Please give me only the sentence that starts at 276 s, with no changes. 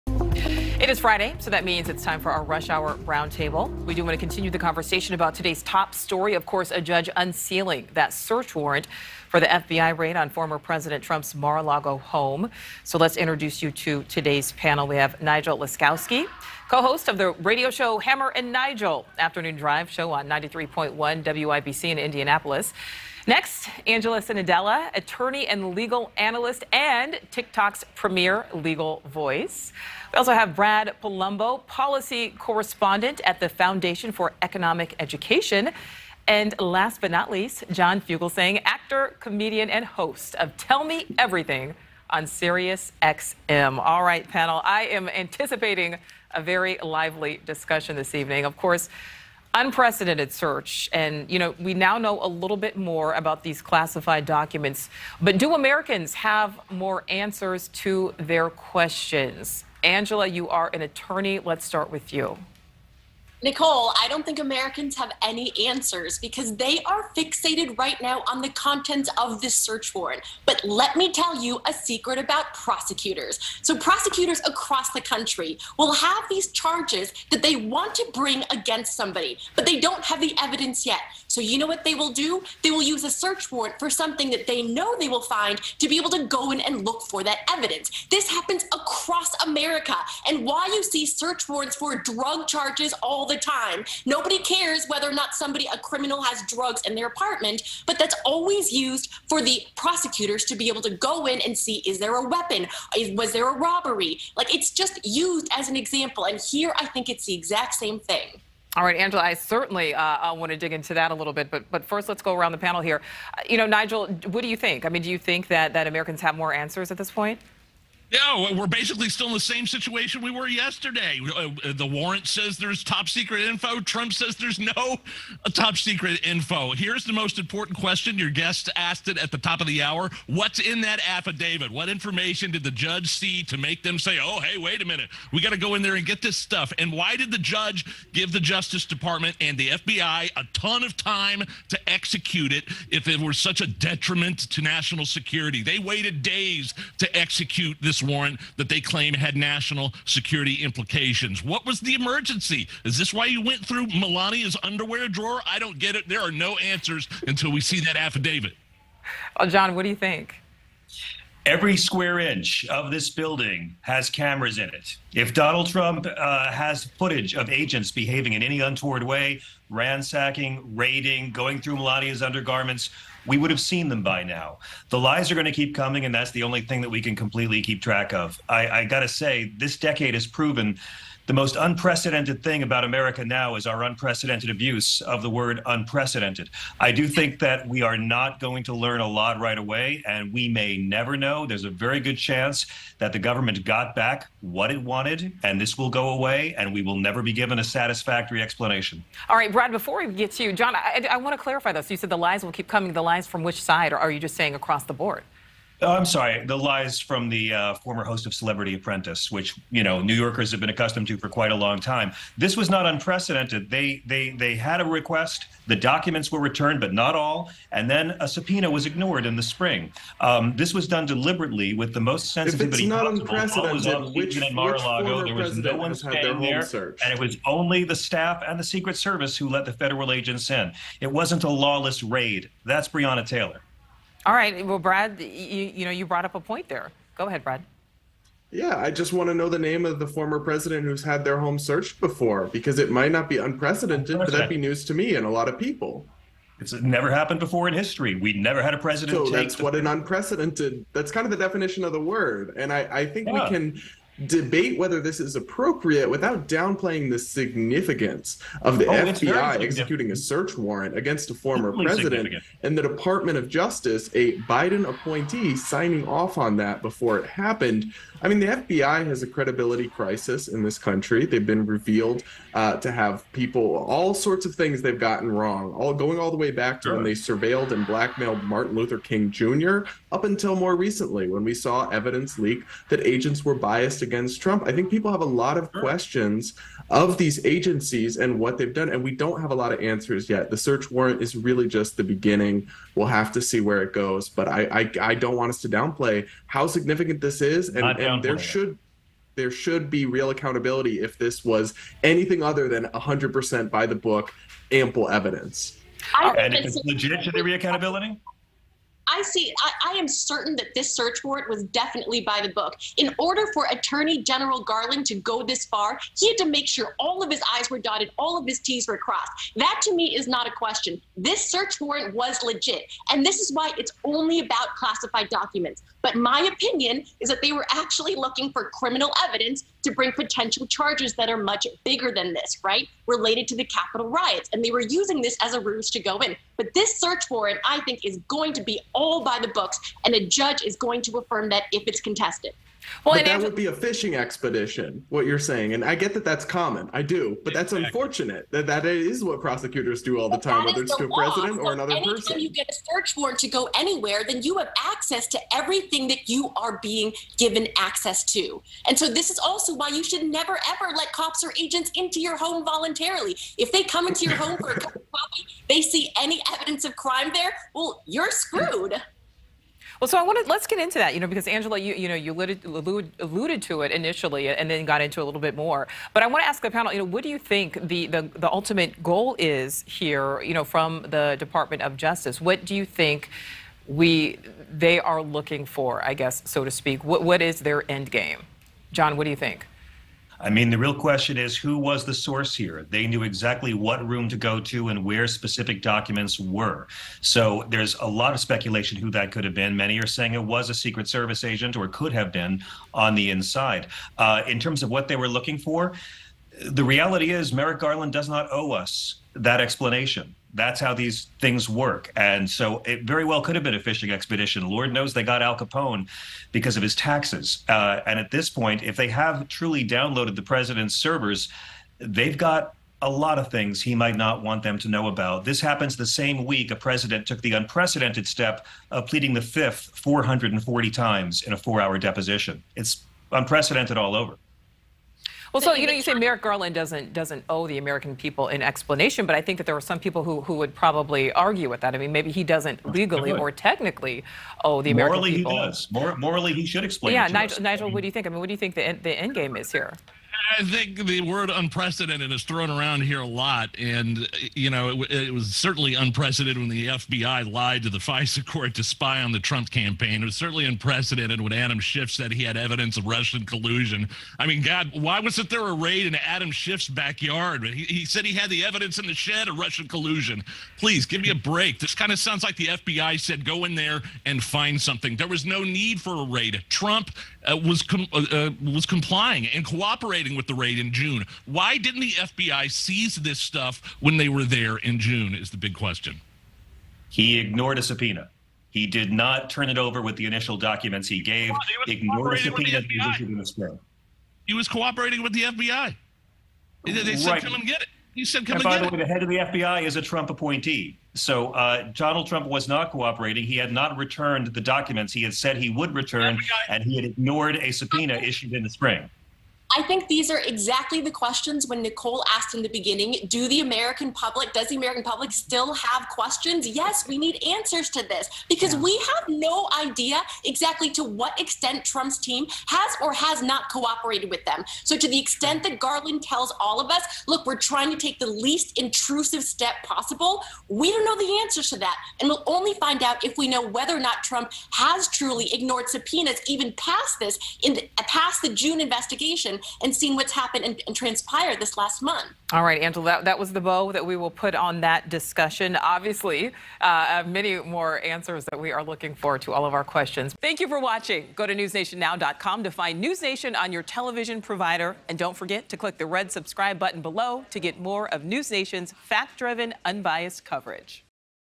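when they surveilled and blackmailed Martin Luther King Jr.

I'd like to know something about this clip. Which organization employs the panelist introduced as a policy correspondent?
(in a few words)
Foundation for Economic Education.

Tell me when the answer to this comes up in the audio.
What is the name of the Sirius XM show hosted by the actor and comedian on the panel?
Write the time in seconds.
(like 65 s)
40 s.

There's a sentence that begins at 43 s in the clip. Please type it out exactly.
All right, panel, I am anticipating a very lively discussion this evening.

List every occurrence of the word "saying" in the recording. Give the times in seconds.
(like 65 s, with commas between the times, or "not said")
204 s, 345 s, 400 s.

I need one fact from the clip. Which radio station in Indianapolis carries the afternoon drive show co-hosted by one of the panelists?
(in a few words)
93.1 WIBC.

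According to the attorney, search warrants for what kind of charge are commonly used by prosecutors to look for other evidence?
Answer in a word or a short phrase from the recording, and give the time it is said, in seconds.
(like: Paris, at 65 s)
drug charges, at 91 s.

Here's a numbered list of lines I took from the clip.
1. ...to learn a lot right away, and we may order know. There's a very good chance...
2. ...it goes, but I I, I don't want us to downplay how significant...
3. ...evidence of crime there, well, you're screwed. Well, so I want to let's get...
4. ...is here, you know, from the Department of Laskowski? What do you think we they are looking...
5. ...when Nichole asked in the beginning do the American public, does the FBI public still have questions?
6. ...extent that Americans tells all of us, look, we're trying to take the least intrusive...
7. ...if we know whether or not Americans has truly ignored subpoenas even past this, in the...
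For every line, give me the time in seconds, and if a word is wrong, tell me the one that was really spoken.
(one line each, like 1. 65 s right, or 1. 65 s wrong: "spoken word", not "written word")
1. 188 s wrong: "never", not "order"
2. 293 s right
3. 366 s right
4. 379 s wrong: "Justice", not "Laskowski"
5. 511 s wrong: "American", not "FBI"
6. 525 s wrong: "Garland", not "Americans"
7. 533 s wrong: "Trump", not "Americans".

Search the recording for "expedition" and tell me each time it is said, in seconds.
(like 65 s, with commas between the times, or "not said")
344 s, 414 s.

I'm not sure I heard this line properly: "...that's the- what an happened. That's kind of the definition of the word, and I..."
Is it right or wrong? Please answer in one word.
wrong.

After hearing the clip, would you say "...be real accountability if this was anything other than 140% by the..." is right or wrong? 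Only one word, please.
wrong.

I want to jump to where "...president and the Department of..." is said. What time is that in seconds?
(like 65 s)
261 s.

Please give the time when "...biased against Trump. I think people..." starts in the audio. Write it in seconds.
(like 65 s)
283 s.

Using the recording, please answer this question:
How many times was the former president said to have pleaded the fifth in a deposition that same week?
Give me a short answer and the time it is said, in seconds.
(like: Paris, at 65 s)
440, at 429 s.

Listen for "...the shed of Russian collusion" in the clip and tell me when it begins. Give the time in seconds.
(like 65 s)
469 s.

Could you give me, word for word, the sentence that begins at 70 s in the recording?
But let me tell you a secret about prosecutors.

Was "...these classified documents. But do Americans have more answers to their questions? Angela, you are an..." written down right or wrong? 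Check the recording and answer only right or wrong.
right.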